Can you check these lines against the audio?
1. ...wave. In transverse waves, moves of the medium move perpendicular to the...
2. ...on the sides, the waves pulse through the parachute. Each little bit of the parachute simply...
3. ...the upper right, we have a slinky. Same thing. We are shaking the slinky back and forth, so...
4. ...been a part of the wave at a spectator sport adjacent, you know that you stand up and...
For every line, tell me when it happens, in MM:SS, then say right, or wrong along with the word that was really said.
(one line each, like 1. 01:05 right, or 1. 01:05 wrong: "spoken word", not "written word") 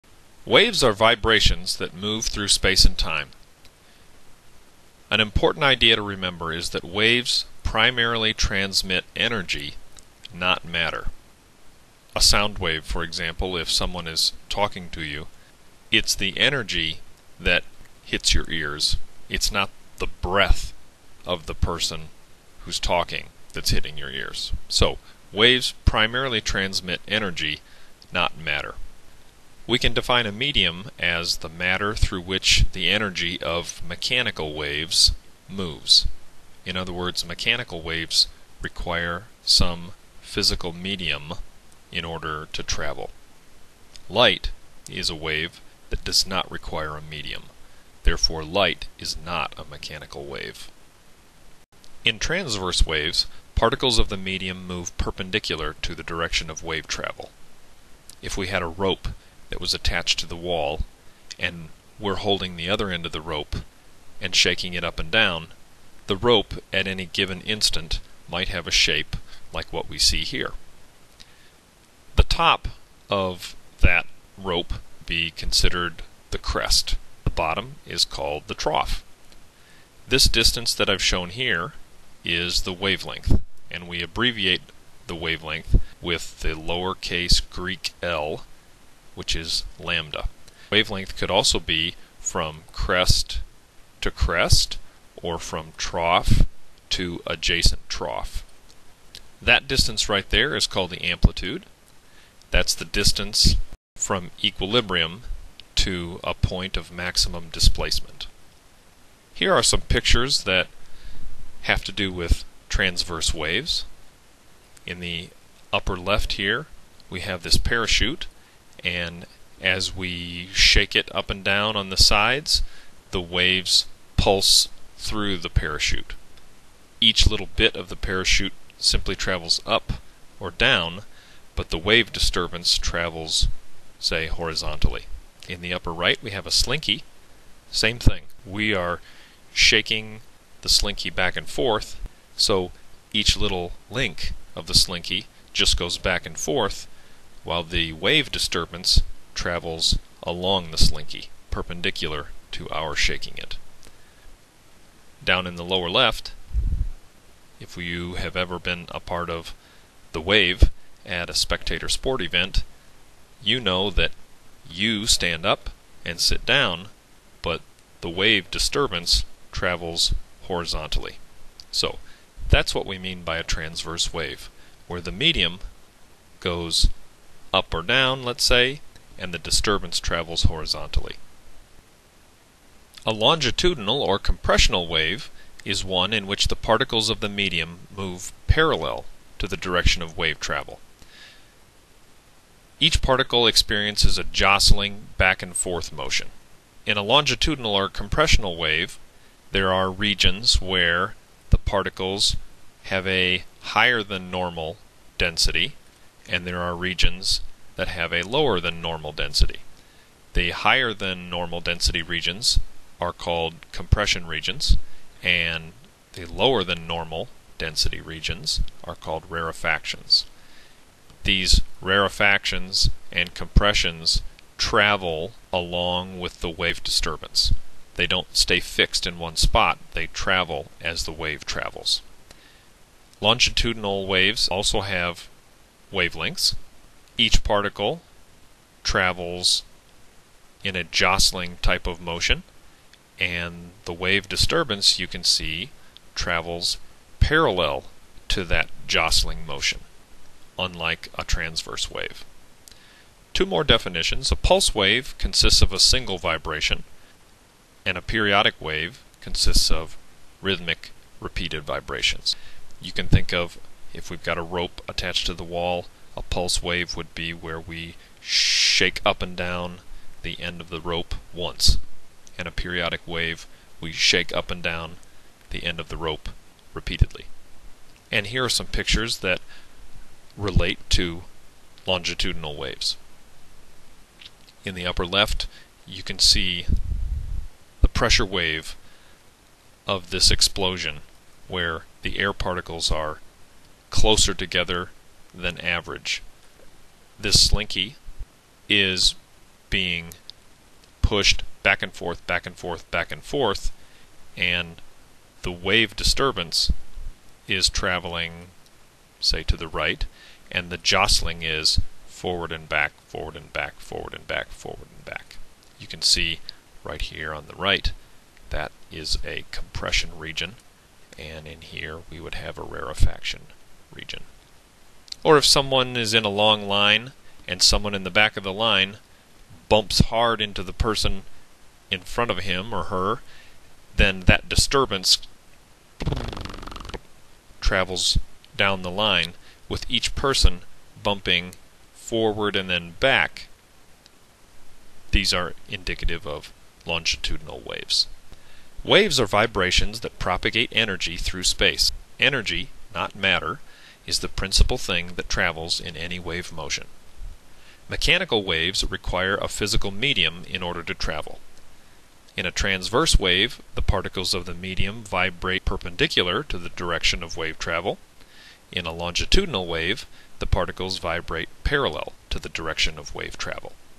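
1. 00:50 wrong: "particles", not "moves"
2. 02:01 right
3. 02:15 right
4. 02:38 wrong: "event", not "adjacent".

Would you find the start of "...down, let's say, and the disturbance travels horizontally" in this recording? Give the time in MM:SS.
02:57.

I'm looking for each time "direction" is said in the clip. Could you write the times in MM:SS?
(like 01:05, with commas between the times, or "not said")
00:56, 03:09, 06:06, 06:12.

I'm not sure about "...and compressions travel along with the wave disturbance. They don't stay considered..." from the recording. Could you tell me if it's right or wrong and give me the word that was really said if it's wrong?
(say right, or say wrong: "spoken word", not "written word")
wrong: "fixed", not "considered".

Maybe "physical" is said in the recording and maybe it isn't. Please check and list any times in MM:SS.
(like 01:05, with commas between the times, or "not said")
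00:40, 05:59.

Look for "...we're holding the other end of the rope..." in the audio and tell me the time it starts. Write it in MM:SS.
01:01.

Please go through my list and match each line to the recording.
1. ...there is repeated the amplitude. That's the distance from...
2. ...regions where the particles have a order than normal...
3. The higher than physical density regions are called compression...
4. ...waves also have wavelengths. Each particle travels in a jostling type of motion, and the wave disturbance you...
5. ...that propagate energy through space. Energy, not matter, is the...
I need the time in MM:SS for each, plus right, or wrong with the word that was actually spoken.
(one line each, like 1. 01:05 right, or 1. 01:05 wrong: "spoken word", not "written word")
1. 01:40 wrong: "called", not "repeated"
2. 03:19 wrong: "higher", not "order"
3. 03:30 wrong: "normal", not "physical"
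4. 03:54 right
5. 05:49 right.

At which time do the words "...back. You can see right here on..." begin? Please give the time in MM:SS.
05:15.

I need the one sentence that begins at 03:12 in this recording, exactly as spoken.
Each particle experiences a jostling back and forth motion.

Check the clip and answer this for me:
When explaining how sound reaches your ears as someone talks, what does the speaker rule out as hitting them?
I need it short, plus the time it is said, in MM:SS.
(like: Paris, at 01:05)
the breath of the person, at 00:19.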